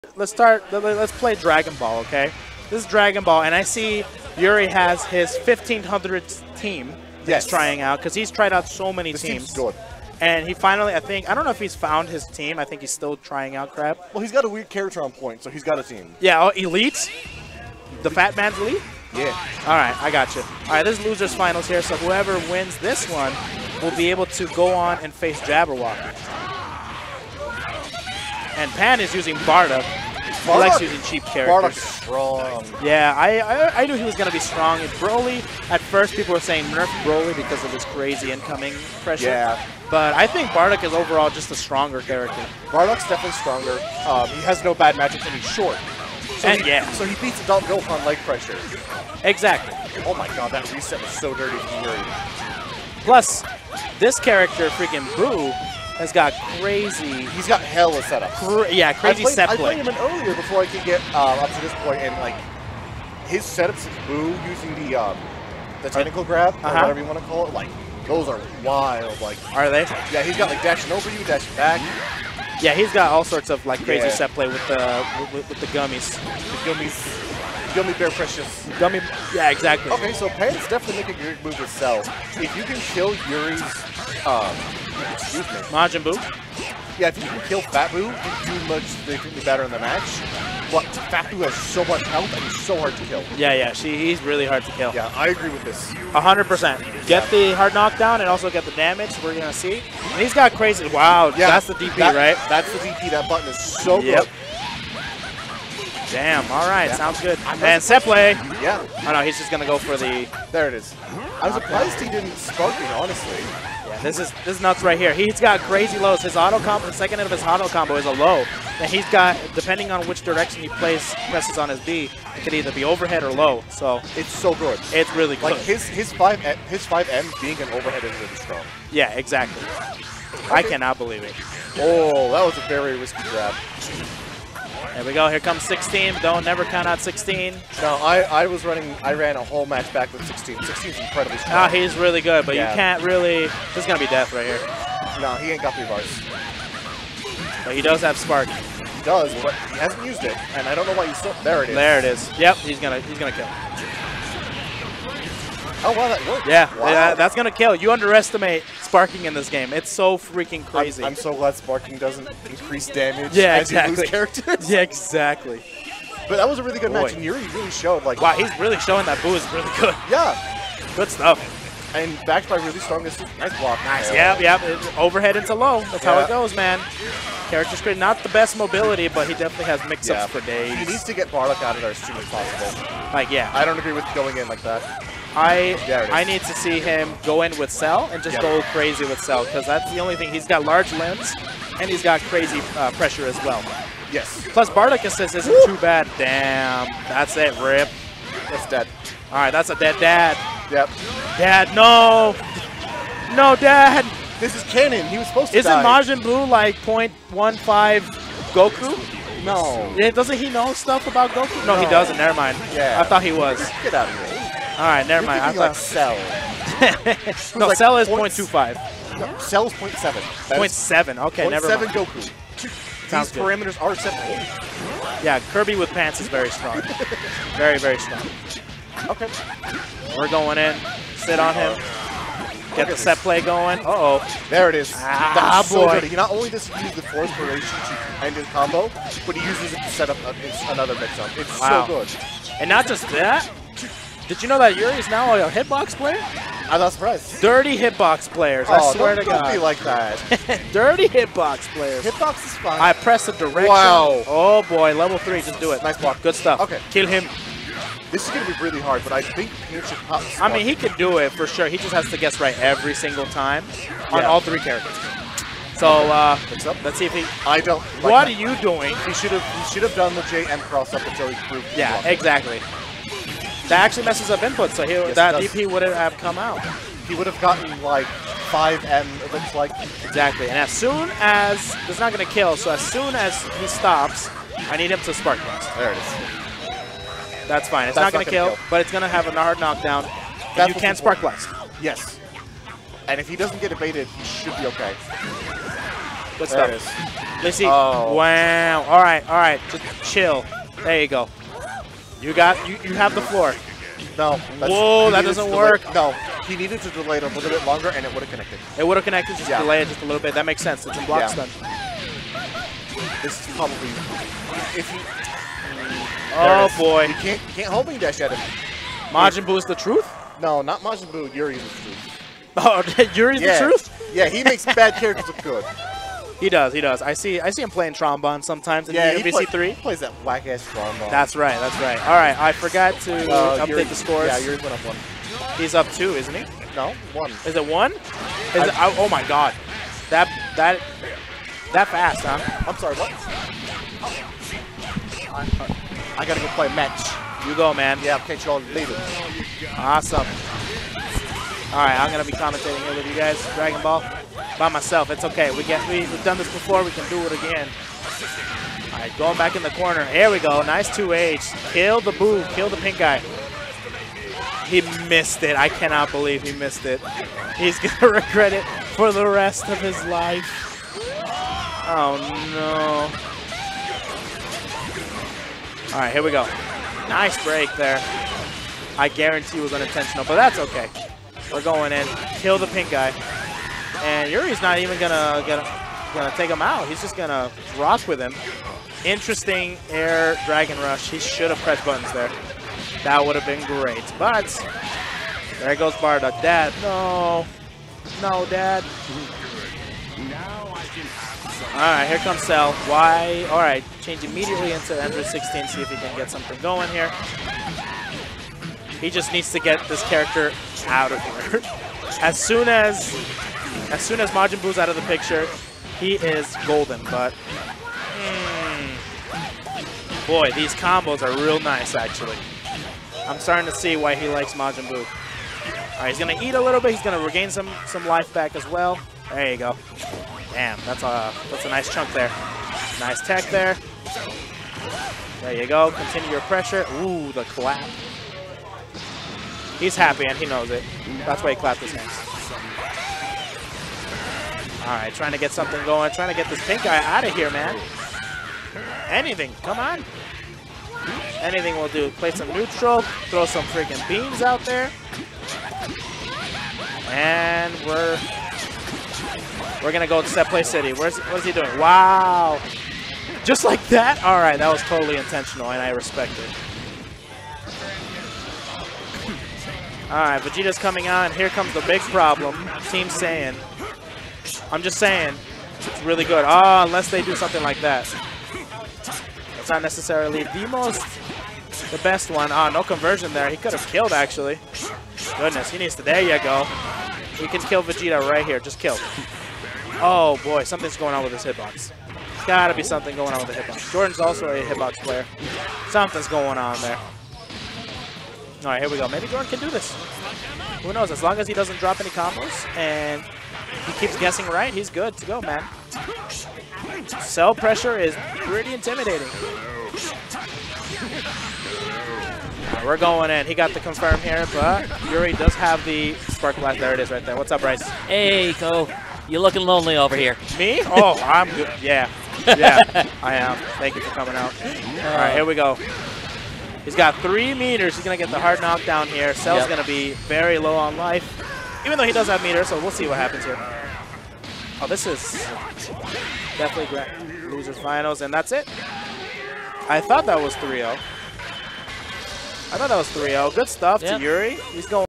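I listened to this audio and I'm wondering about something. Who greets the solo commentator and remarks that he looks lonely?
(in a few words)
Bryce.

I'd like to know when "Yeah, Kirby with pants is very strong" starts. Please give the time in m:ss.
3:45.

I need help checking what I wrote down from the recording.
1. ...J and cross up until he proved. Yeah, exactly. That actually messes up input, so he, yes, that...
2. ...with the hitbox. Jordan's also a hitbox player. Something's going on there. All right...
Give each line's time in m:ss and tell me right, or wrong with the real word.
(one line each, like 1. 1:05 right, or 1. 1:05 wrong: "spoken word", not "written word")
1. 4:30 right
2. 8:13 right.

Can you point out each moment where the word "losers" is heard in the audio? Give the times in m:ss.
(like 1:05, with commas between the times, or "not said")
0:21, 8:57.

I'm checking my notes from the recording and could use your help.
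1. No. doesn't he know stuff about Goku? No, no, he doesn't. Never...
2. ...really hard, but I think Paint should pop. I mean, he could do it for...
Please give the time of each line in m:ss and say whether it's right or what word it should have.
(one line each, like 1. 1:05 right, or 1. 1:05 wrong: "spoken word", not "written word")
1. 3:29 right
2. 4:18 right.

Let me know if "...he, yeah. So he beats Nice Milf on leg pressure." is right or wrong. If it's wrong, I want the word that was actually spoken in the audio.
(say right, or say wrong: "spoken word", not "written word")
wrong: "Adult", not "Nice".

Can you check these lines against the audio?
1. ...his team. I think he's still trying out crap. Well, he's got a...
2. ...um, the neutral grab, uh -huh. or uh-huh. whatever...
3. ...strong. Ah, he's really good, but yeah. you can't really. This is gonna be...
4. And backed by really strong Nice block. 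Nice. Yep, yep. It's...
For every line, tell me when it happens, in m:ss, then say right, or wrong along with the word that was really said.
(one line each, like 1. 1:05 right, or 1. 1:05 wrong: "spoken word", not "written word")
1. 0:12 right
2. 1:04 wrong: "technical", not "neutral"
3. 2:21 right
4. 2:51 right.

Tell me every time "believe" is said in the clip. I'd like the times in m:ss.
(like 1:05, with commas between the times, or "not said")
2:10, 6:06.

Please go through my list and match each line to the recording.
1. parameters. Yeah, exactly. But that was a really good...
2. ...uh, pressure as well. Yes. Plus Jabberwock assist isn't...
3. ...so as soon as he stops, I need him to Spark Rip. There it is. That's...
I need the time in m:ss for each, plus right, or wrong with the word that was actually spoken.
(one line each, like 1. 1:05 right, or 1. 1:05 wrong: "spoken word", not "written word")
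1. 2:44 wrong: "characters", not "parameters"
2. 3:12 wrong: "Bardock", not "Jabberwock"
3. 4:42 wrong: "Blast", not "Rip".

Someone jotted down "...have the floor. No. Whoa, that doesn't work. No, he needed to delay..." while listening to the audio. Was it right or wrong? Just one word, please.
right.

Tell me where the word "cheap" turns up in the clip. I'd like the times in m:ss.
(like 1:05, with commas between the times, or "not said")
0:31.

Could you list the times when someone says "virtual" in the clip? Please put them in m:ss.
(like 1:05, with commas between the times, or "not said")
not said.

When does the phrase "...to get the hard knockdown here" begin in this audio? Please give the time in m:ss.
8:48.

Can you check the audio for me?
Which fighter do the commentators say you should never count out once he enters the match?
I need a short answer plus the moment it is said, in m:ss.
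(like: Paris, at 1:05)
16, at 2:16.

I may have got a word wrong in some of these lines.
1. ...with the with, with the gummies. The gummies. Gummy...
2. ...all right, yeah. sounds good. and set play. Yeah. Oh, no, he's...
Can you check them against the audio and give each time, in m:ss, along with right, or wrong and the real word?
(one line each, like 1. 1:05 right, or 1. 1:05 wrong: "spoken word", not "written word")
1. 1:14 right
2. 1:46 right.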